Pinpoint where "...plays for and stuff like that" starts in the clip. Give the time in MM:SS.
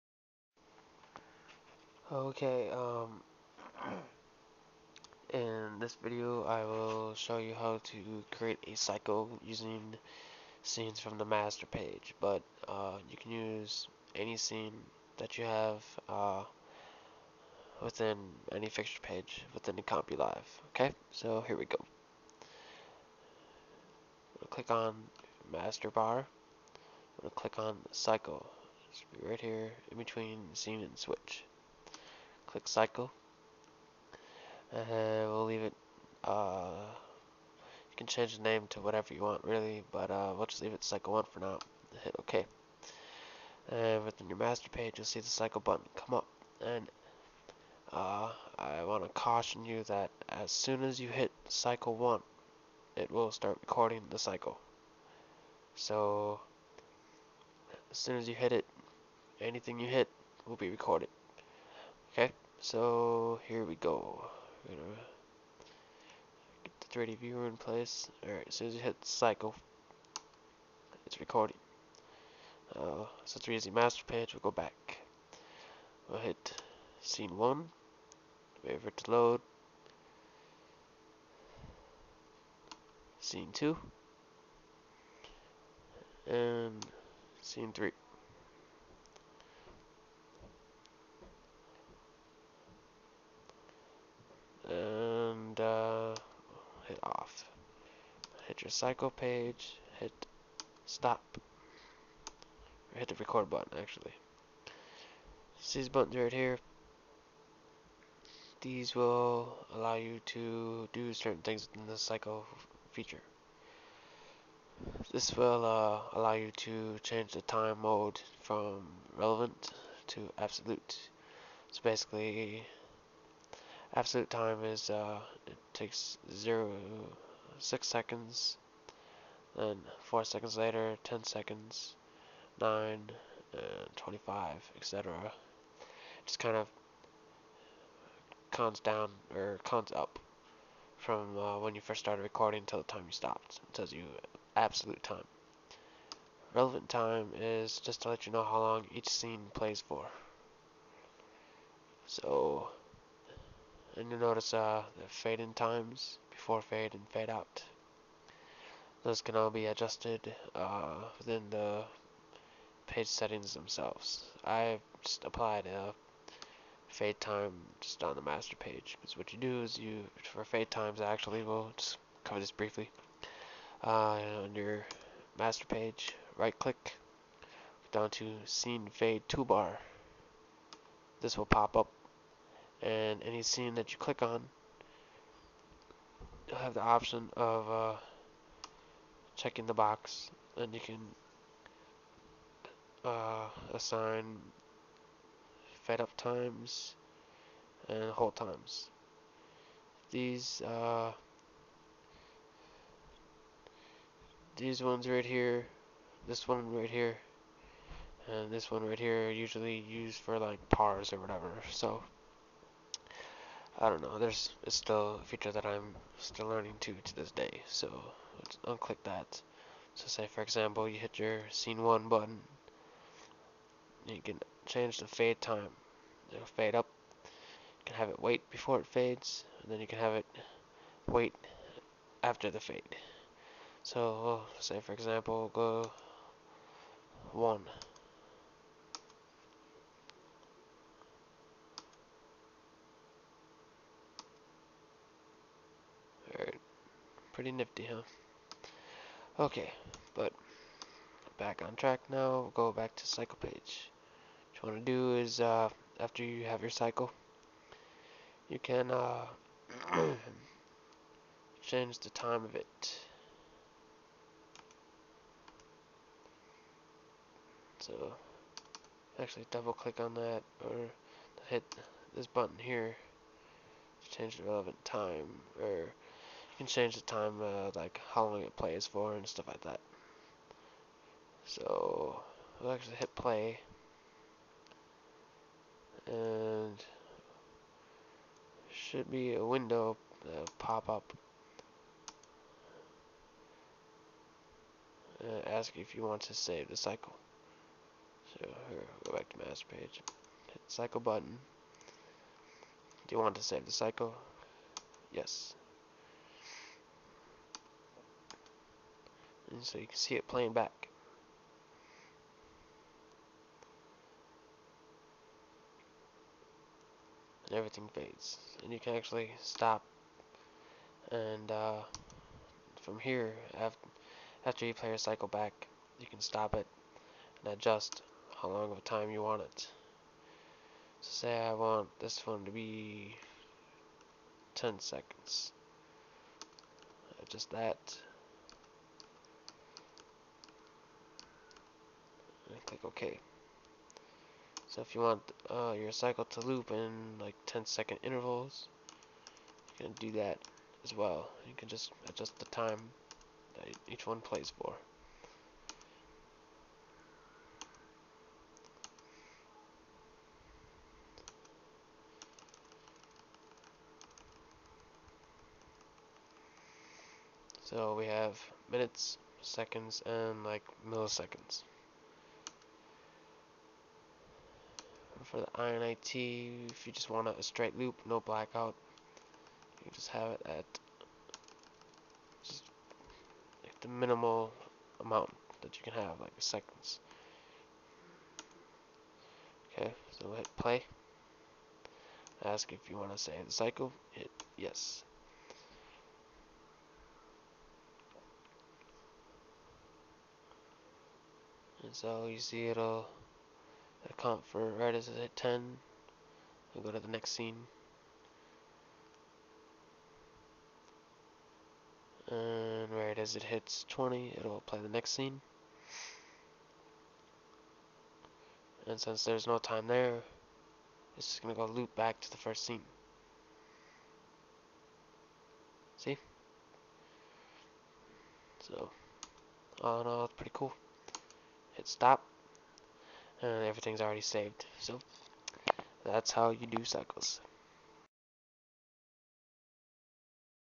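04:38.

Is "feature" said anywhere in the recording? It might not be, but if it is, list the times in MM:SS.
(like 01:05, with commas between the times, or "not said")
01:52, 03:35.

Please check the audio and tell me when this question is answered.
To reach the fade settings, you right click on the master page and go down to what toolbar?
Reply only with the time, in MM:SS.
02:58.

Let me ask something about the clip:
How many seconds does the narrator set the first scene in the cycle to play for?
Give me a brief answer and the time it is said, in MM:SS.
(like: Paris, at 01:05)
10, at 05:34.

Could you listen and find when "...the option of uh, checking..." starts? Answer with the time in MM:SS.
03:06.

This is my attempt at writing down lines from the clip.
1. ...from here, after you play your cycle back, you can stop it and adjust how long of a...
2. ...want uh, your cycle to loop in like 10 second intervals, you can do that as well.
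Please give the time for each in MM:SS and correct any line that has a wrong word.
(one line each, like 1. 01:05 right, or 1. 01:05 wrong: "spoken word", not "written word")
1. 05:22 right
2. 05:45 right.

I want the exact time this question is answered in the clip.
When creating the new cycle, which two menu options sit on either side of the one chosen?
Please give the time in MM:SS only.
00:29.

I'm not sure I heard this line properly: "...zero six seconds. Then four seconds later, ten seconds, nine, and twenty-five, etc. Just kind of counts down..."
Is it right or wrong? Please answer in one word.
right.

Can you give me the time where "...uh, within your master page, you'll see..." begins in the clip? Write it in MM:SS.
00:44.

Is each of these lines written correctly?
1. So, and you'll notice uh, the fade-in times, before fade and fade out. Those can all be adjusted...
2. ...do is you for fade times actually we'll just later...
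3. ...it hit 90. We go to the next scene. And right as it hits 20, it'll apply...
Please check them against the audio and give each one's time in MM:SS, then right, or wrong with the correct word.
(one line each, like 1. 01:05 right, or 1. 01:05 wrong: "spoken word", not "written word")
1. 02:32 right
2. 02:49 wrong: "cover", not "later"
3. 06:45 wrong: "10", not "90".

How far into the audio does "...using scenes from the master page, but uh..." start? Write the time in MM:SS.
00:09.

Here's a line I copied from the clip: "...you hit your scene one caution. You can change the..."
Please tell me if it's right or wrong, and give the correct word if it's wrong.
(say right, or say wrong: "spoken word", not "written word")
wrong: "button", not "caution".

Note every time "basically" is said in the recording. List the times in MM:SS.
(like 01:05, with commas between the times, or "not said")
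02:01.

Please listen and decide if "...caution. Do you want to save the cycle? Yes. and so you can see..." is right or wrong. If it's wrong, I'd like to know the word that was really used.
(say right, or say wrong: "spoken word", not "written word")
wrong: "button", not "caution".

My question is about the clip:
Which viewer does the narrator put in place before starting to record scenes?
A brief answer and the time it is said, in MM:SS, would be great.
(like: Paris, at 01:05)
3D viewer, at 01:06.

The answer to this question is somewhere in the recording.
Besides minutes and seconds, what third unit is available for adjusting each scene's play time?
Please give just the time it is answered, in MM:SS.
06:10.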